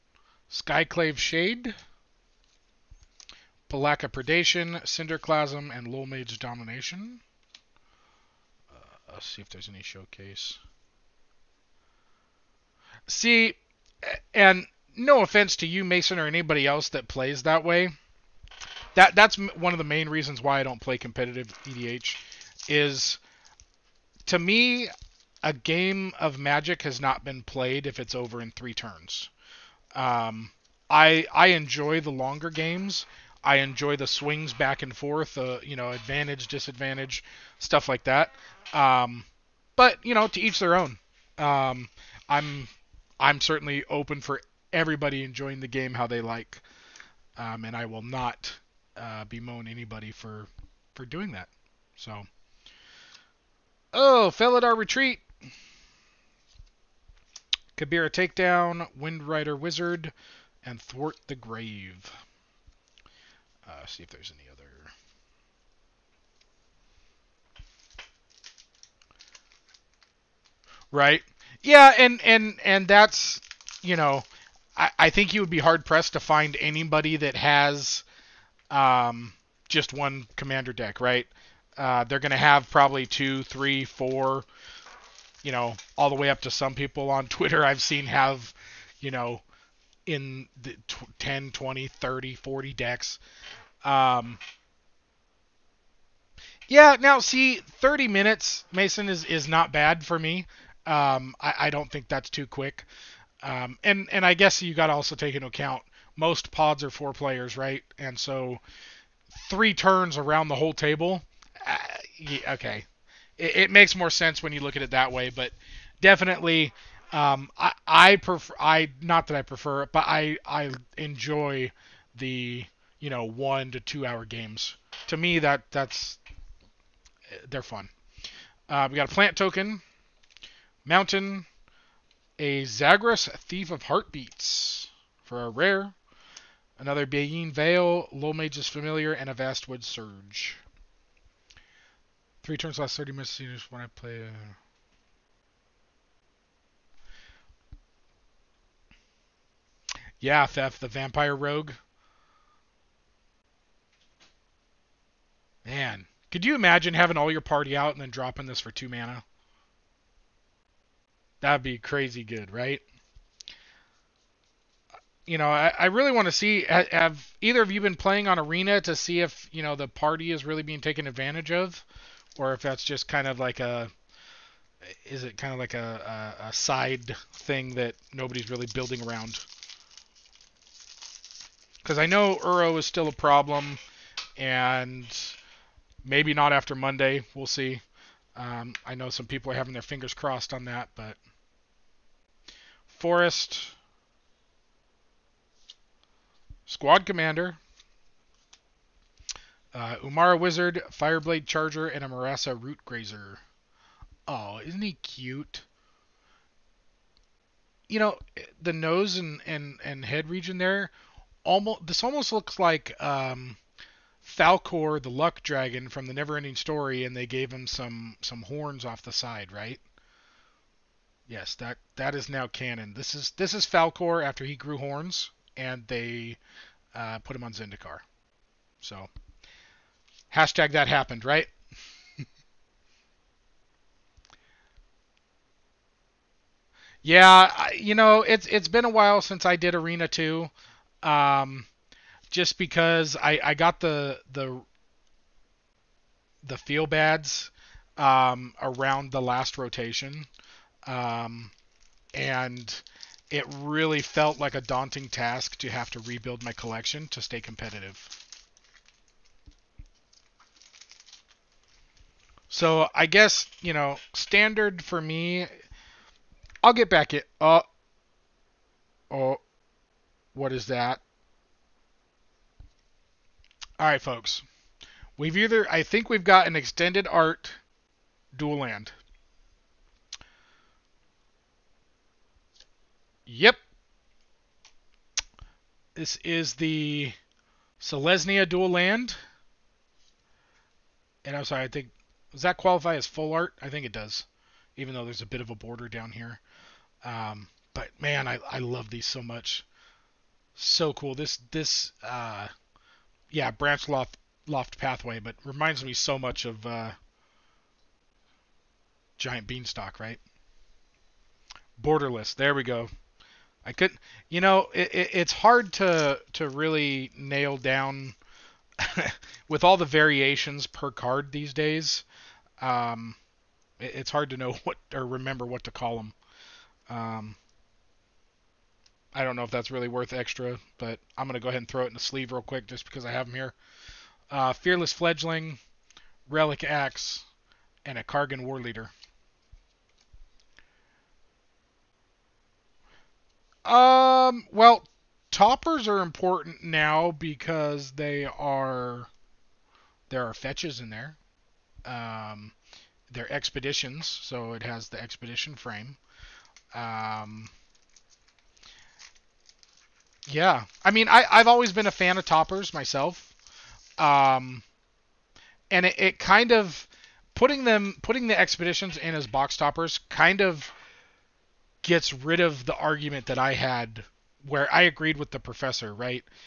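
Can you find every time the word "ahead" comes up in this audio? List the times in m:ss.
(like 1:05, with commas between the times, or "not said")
5:31.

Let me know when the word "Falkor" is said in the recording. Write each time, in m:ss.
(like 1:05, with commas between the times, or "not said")
3:34, 3:43.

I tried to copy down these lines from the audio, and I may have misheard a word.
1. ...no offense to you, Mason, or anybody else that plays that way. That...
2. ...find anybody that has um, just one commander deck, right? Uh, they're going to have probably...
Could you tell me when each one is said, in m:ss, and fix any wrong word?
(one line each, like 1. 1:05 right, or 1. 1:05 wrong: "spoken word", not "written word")
1. 0:14 right
2. 1:16 right.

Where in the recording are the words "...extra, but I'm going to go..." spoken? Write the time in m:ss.
5:30.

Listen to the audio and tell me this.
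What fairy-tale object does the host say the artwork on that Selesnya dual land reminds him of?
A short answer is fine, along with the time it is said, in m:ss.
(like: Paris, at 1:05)
Giant beanstalk, at 5:09.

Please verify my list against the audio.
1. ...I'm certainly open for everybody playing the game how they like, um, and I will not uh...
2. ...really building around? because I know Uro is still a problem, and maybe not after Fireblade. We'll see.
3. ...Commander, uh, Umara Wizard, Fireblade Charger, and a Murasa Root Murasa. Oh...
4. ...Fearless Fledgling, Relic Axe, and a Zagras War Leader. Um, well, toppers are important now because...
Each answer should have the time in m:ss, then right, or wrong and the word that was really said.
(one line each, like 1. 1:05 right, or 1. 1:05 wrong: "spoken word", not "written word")
1. 0:43 wrong: "enjoying", not "playing"
2. 2:58 wrong: "Monday", not "Fireblade"
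3. 3:17 wrong: "Grazer", not "Murasa"
4. 5:34 wrong: "Kargan", not "Zagras".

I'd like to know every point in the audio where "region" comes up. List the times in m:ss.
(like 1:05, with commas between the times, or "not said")
3:30.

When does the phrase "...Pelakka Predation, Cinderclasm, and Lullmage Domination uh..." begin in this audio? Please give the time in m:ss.
0:03.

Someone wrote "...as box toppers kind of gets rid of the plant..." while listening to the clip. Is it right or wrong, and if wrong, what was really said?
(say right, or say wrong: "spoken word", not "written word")
wrong: "argument", not "plant".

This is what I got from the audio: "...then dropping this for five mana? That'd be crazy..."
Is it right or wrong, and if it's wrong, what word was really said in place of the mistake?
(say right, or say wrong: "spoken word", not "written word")
wrong: "two", not "five".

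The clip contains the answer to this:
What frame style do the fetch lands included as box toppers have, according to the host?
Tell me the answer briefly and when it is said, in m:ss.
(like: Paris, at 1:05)
Expedition frame, at 5:54.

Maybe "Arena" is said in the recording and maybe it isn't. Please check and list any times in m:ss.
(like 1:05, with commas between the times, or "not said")
2:48, 3:59.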